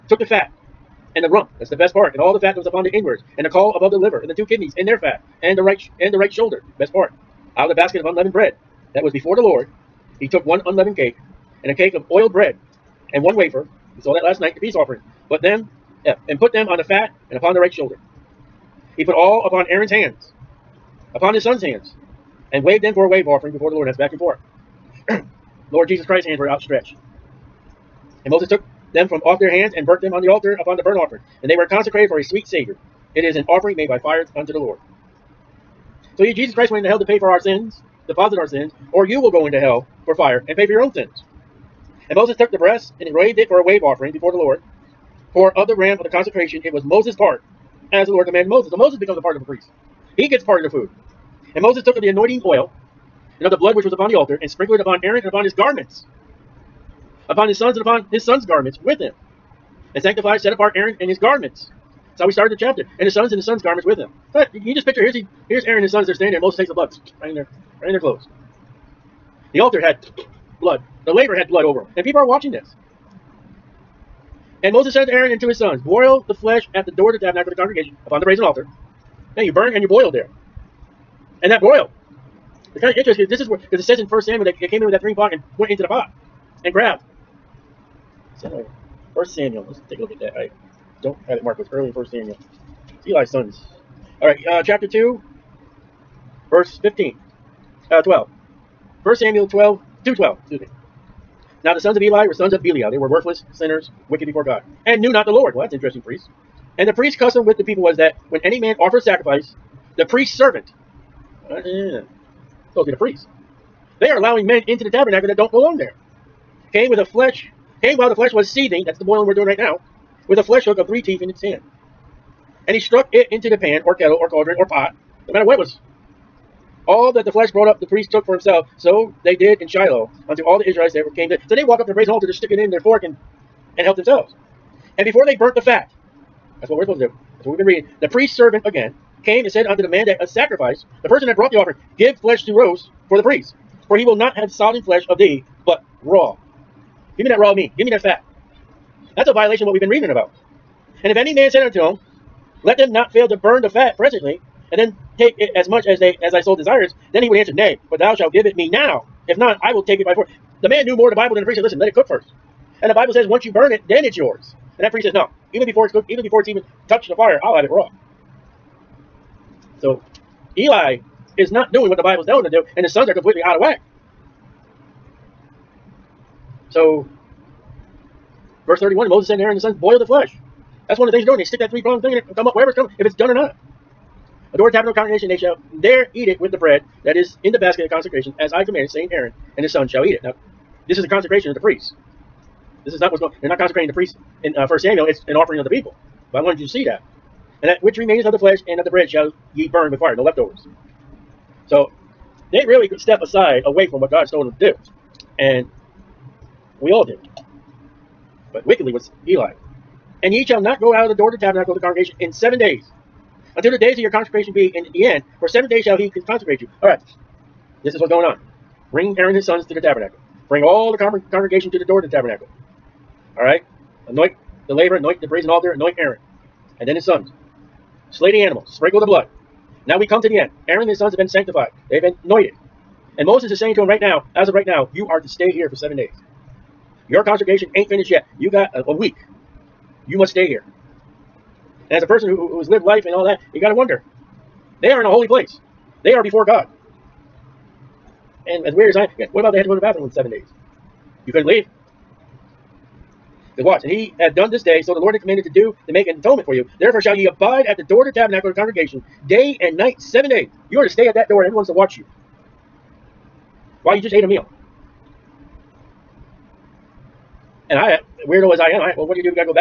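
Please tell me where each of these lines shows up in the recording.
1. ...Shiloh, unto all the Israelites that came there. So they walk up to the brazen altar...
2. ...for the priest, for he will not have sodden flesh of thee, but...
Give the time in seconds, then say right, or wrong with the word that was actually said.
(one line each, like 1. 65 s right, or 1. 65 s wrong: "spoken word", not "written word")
1. 129 s right
2. 143 s right.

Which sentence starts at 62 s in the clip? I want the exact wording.
That's how we started the chapter.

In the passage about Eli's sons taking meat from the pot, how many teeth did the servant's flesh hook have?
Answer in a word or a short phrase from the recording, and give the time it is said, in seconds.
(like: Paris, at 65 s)
3, at 120 s.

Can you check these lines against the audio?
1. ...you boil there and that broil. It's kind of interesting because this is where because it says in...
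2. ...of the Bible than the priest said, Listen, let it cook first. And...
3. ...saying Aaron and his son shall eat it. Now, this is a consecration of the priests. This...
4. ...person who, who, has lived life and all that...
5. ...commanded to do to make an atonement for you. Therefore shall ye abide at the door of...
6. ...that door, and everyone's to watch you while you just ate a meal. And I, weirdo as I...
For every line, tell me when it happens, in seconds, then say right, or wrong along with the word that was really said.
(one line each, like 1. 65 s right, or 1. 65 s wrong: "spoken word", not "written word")
1. 79 s right
2. 161 s right
3. 188 s right
4. 242 s right
5. 255 s right
6. 261 s right.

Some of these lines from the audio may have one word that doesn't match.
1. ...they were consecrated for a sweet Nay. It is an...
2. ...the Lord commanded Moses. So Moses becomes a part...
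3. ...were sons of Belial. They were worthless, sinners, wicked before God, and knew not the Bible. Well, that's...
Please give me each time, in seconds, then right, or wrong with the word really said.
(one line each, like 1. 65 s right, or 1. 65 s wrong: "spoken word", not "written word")
1. 31 s wrong: "Savior", not "Nay"
2. 48 s right
3. 102 s wrong: "Lord", not "Bible".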